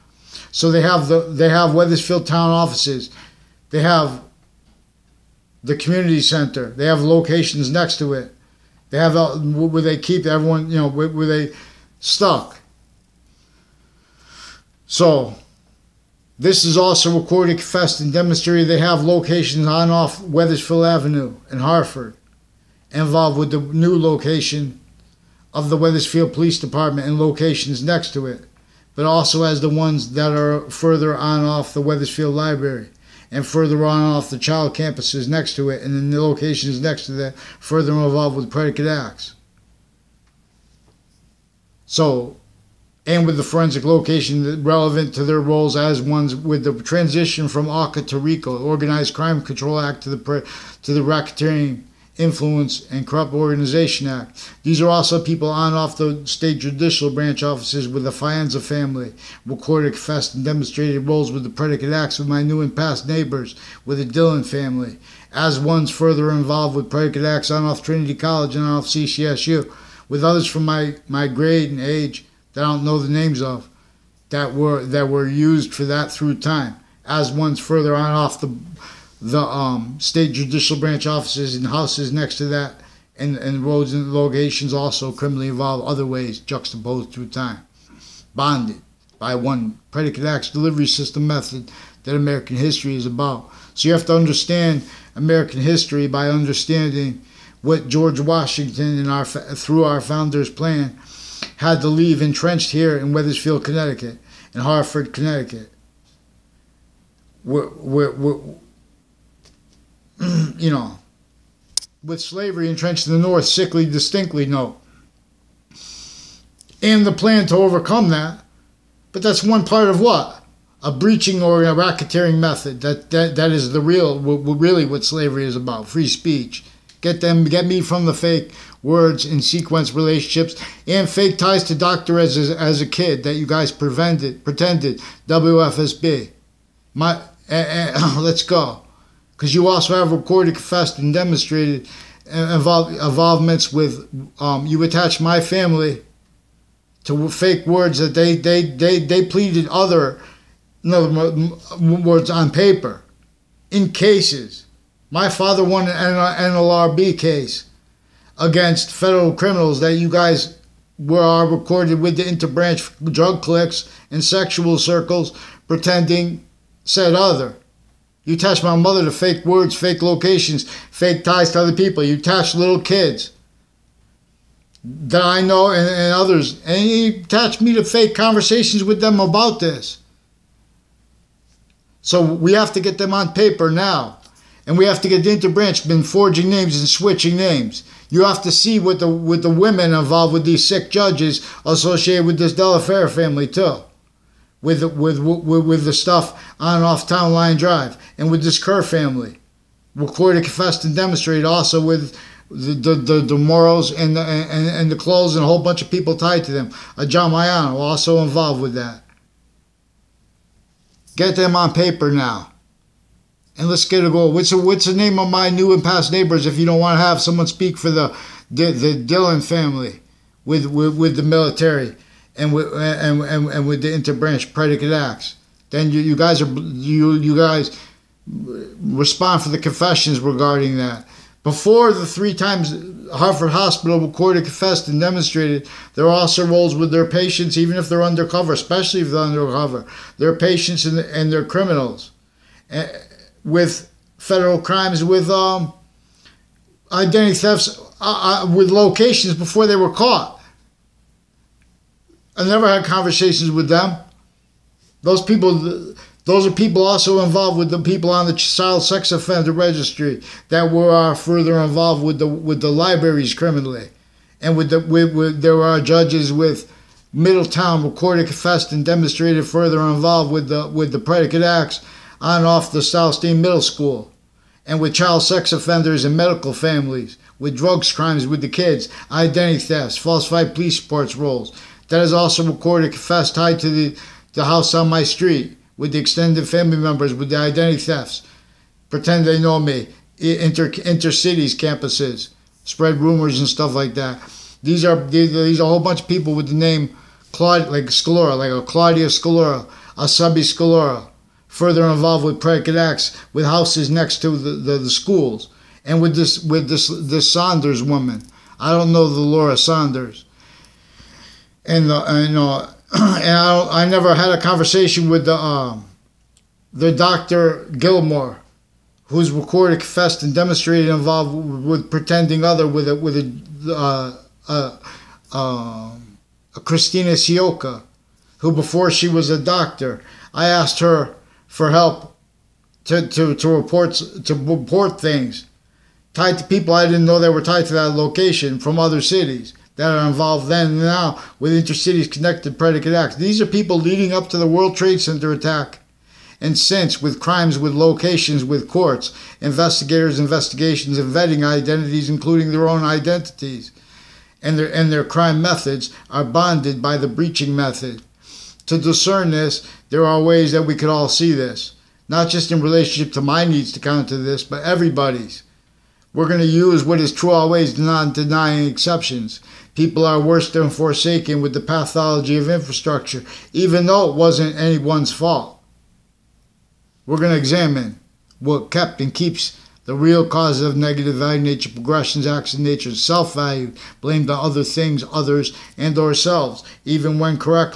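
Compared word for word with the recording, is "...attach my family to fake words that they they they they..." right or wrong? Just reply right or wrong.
right.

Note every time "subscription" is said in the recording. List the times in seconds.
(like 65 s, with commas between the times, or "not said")
not said.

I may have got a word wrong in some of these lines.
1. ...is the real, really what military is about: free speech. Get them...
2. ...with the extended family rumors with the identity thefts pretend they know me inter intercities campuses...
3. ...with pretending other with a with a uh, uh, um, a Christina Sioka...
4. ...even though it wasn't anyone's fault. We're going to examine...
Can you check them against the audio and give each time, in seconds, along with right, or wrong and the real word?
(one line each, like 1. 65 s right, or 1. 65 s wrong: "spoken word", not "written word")
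1. 123 s wrong: "slavery", not "military"
2. 285 s wrong: "members", not "rumors"
3. 321 s right
4. 373 s right.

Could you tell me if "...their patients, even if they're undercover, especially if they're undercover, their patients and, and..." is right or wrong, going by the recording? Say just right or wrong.
right.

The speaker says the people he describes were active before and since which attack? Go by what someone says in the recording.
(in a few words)
World Trade Center attack.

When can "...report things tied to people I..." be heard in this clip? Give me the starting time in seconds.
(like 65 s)
334 s.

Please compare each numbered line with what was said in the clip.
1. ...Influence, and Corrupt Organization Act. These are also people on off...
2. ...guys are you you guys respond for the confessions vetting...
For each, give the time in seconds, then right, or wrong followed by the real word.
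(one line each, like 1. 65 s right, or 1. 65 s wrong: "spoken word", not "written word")
1. 52 s right
2. 226 s wrong: "regarding", not "vetting".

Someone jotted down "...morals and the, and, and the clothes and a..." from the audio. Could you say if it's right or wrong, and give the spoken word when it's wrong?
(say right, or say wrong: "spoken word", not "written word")
right.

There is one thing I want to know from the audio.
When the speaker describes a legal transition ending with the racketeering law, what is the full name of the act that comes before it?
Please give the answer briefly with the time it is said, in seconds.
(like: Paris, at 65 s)
Organized Crime Control Act, at 48 s.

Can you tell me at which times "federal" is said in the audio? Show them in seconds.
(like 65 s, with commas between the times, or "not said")
158 s, 244 s.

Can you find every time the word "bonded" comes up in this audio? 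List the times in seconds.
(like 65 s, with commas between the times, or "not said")
88 s, 356 s.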